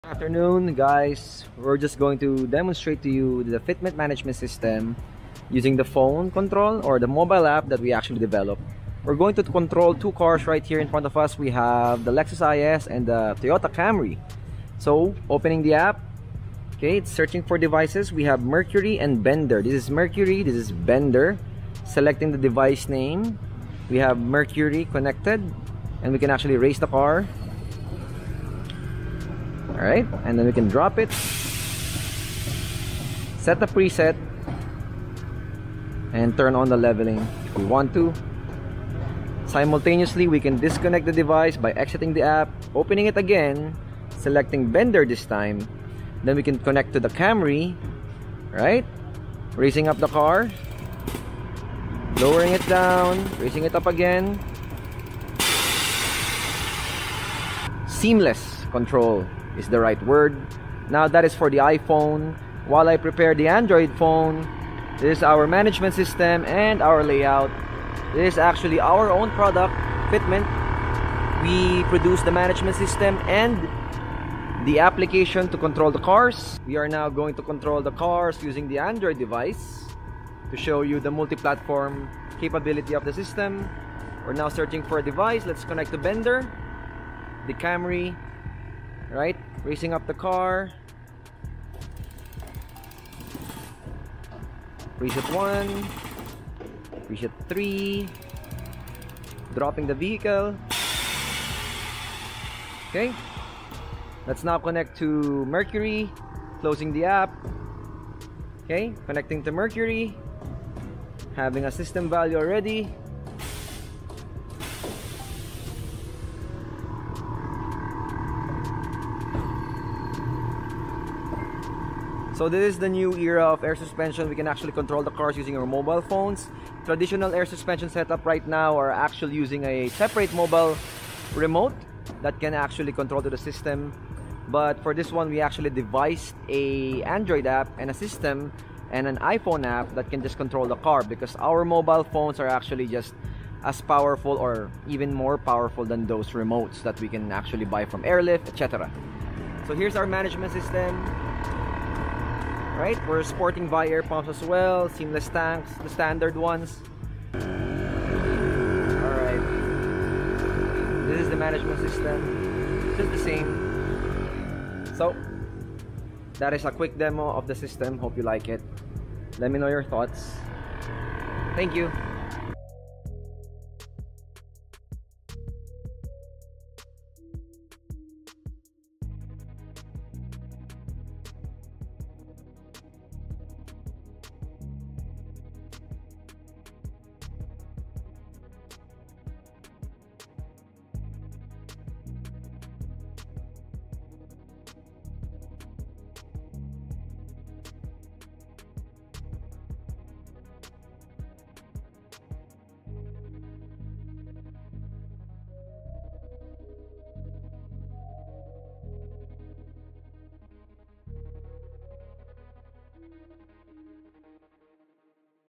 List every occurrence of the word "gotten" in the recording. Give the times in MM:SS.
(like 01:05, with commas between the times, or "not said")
not said.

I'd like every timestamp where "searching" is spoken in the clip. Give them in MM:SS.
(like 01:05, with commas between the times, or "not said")
00:17, 01:24.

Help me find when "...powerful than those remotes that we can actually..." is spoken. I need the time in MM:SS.
02:25.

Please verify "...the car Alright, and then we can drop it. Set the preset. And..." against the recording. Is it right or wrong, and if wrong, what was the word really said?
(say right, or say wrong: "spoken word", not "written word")
right.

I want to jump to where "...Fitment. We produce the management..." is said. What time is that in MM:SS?
01:10.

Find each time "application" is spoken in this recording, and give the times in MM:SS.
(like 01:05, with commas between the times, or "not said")
01:14.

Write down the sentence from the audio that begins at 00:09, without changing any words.
We're going to control two cars right here in front of us.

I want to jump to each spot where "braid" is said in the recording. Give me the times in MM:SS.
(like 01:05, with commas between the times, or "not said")
not said.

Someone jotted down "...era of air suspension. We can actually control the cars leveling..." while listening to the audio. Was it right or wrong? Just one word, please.
wrong.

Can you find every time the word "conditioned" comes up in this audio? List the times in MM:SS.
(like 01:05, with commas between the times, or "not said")
not said.